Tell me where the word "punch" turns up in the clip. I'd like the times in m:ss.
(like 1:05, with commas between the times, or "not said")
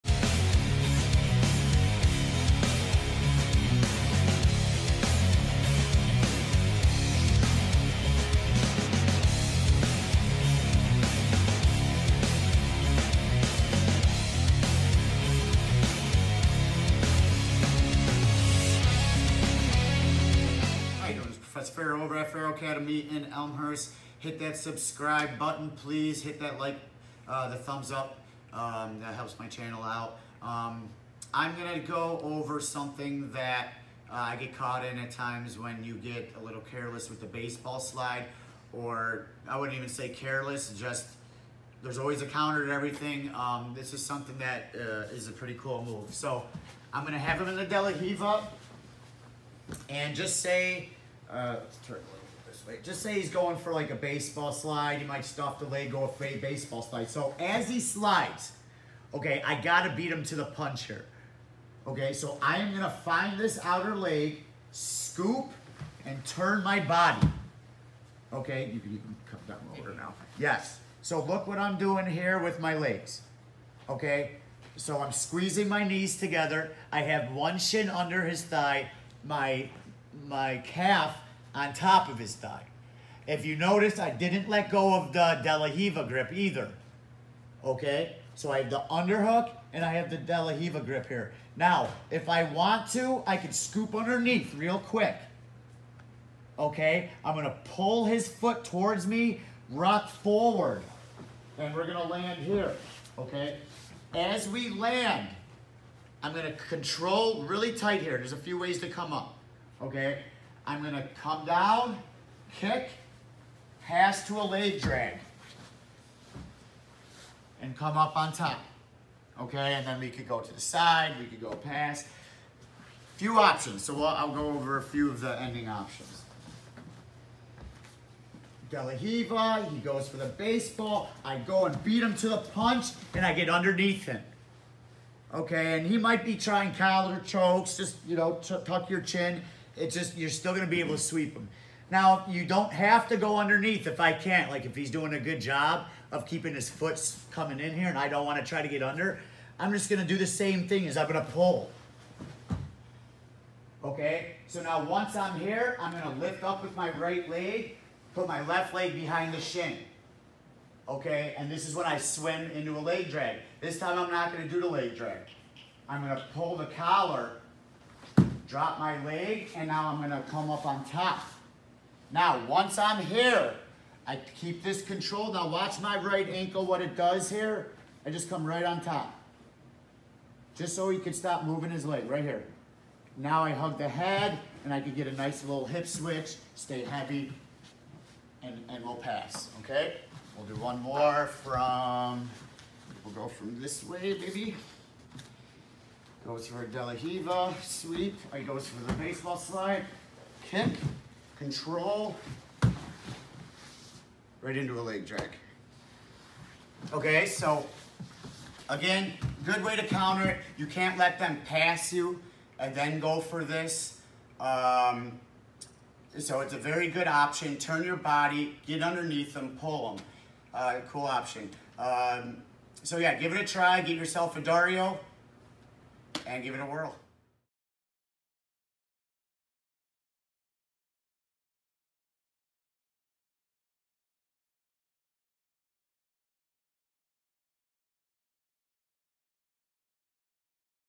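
1:00, 2:12.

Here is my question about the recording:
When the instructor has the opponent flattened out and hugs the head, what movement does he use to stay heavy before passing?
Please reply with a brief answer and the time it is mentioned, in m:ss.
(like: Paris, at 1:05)
hip switch, at 3:05.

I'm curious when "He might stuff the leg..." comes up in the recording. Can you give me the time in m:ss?
0:54.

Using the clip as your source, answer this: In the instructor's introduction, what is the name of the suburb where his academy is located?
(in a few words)
Elmhurst.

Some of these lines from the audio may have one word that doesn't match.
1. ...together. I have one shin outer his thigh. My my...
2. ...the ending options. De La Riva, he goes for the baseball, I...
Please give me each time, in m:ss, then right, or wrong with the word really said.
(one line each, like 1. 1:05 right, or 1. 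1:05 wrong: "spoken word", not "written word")
1. 1:16 wrong: "under", not "outer"
2. 2:05 right.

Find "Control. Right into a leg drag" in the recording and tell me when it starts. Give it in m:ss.
3:21.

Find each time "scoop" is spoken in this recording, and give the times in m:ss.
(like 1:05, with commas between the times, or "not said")
1:04, 1:33.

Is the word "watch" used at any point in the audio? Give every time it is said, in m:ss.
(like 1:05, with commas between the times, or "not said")
2:55.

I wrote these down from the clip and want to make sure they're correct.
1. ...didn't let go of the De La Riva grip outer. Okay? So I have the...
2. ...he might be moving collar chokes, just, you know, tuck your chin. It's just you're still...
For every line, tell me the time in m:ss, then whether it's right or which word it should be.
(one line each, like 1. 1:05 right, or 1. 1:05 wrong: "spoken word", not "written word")
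1. 1:24 wrong: "either", not "outer"
2. 2:15 wrong: "trying", not "moving".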